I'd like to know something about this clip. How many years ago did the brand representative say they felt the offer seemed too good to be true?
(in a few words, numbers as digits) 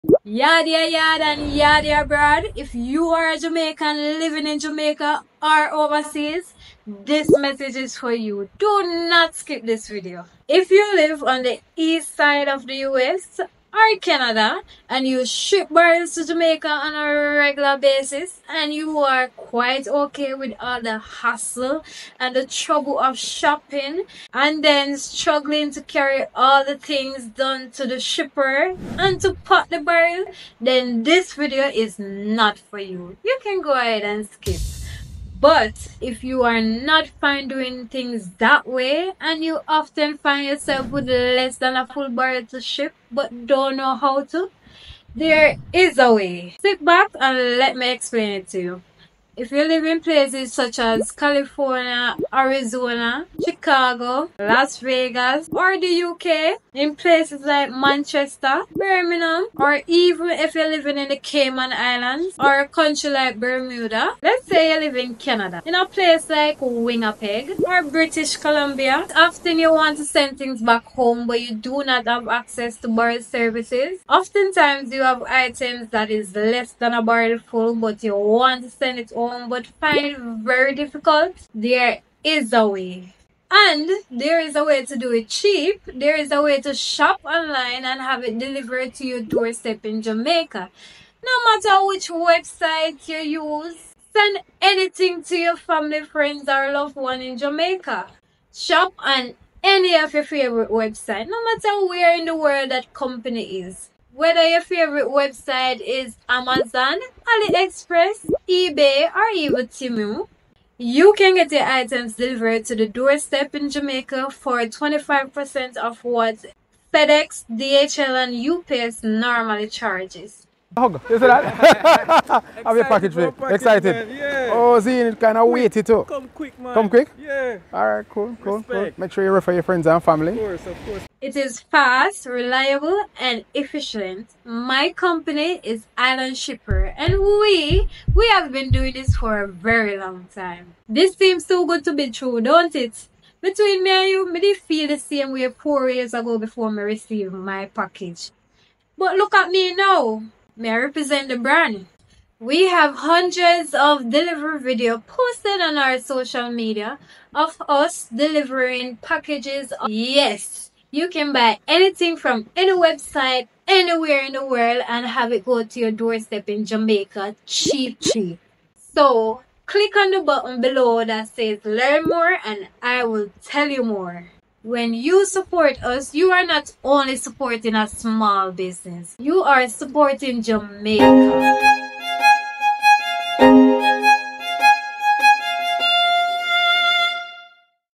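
4.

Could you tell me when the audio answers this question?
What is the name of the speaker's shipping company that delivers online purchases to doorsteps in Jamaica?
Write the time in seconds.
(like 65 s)
136 s.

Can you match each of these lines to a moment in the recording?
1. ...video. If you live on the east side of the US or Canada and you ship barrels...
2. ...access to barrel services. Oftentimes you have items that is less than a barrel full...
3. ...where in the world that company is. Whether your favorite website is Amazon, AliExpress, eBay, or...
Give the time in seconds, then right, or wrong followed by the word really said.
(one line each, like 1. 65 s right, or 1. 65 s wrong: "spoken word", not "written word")
1. 9 s right
2. 72 s right
3. 101 s right.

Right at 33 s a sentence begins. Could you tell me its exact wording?
You can go ahead and skip.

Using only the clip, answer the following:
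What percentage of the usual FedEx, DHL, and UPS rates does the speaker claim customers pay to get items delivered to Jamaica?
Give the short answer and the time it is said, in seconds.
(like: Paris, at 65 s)
25%, at 114 s.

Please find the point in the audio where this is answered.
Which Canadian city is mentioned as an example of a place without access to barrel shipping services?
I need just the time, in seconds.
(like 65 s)
66 s.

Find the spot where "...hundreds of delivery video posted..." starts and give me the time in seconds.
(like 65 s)
152 s.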